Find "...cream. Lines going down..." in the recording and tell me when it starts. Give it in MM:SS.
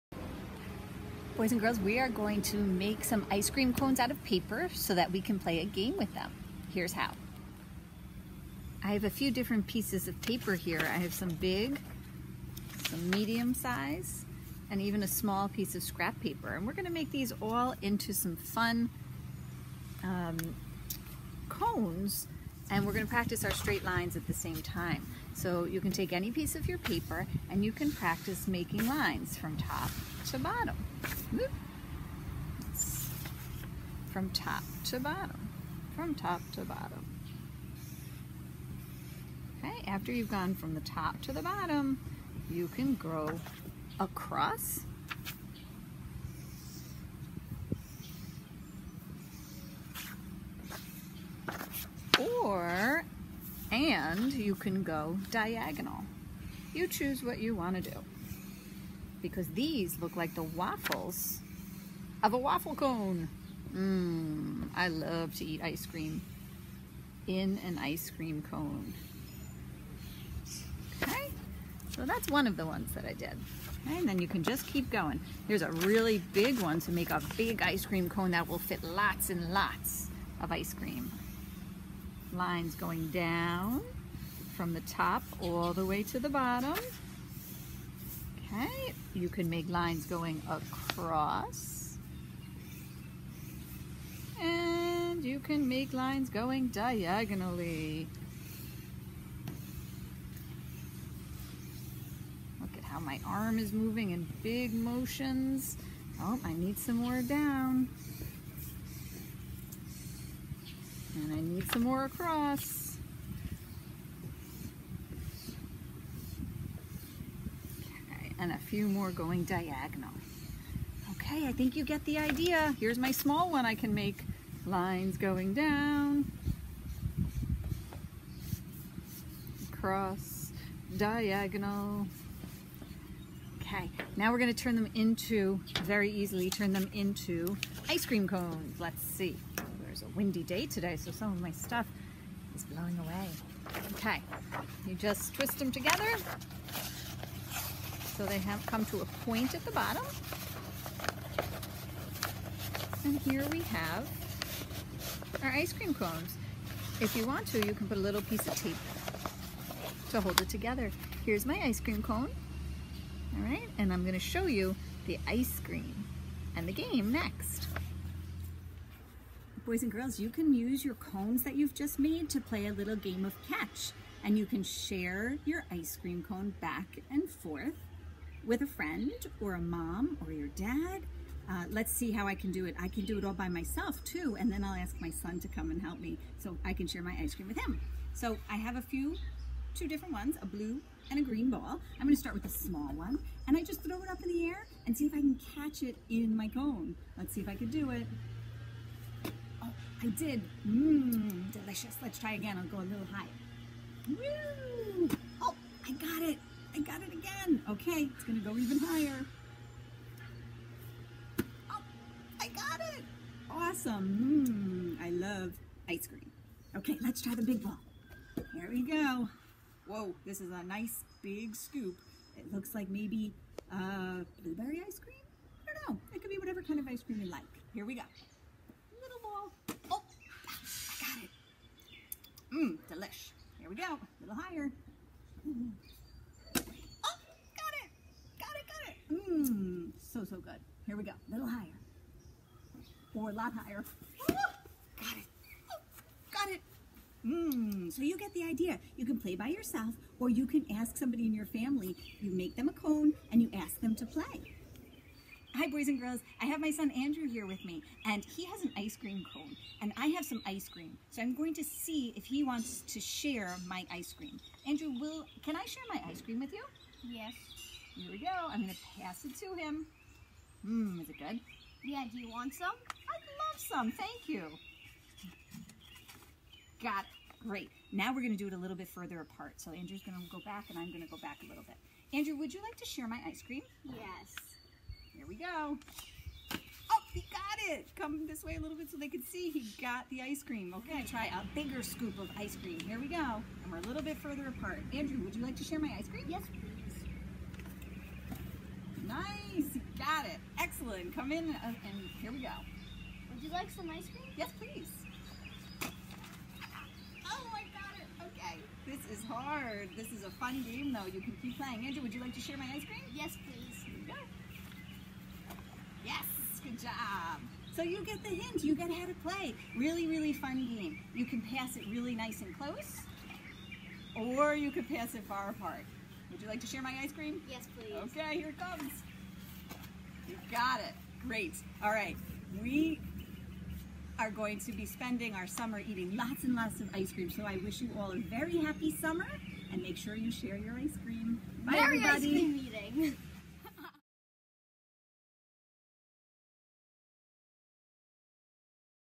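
01:20.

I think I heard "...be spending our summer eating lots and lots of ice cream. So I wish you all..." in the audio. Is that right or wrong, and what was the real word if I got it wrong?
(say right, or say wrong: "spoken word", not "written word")
right.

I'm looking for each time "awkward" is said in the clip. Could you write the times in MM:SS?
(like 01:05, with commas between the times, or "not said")
not said.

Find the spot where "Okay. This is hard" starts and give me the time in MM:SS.
05:08.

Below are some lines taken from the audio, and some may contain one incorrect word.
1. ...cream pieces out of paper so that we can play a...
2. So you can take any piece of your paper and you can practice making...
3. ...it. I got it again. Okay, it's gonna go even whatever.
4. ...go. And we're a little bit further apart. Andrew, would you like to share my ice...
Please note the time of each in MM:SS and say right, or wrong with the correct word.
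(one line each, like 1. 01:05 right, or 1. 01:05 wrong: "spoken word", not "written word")
1. 00:03 wrong: "cones", not "pieces"
2. 00:25 right
3. 03:26 wrong: "higher", not "whatever"
4. 04:53 right.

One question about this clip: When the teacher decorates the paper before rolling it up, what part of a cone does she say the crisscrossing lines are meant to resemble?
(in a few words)
The waffles.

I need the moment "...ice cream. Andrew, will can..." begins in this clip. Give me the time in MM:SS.
04:23.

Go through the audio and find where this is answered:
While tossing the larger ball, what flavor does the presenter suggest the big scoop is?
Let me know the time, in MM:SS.
03:44.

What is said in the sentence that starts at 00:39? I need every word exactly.
Okay, after you've gone from the top to the bottom, you can grow across or and you can go diagonal.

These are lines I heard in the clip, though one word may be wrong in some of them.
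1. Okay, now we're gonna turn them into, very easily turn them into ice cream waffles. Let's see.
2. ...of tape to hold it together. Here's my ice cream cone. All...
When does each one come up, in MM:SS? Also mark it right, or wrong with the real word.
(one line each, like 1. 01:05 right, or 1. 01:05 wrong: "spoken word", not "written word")
1. 02:13 wrong: "cones", not "waffles"
2. 02:38 right.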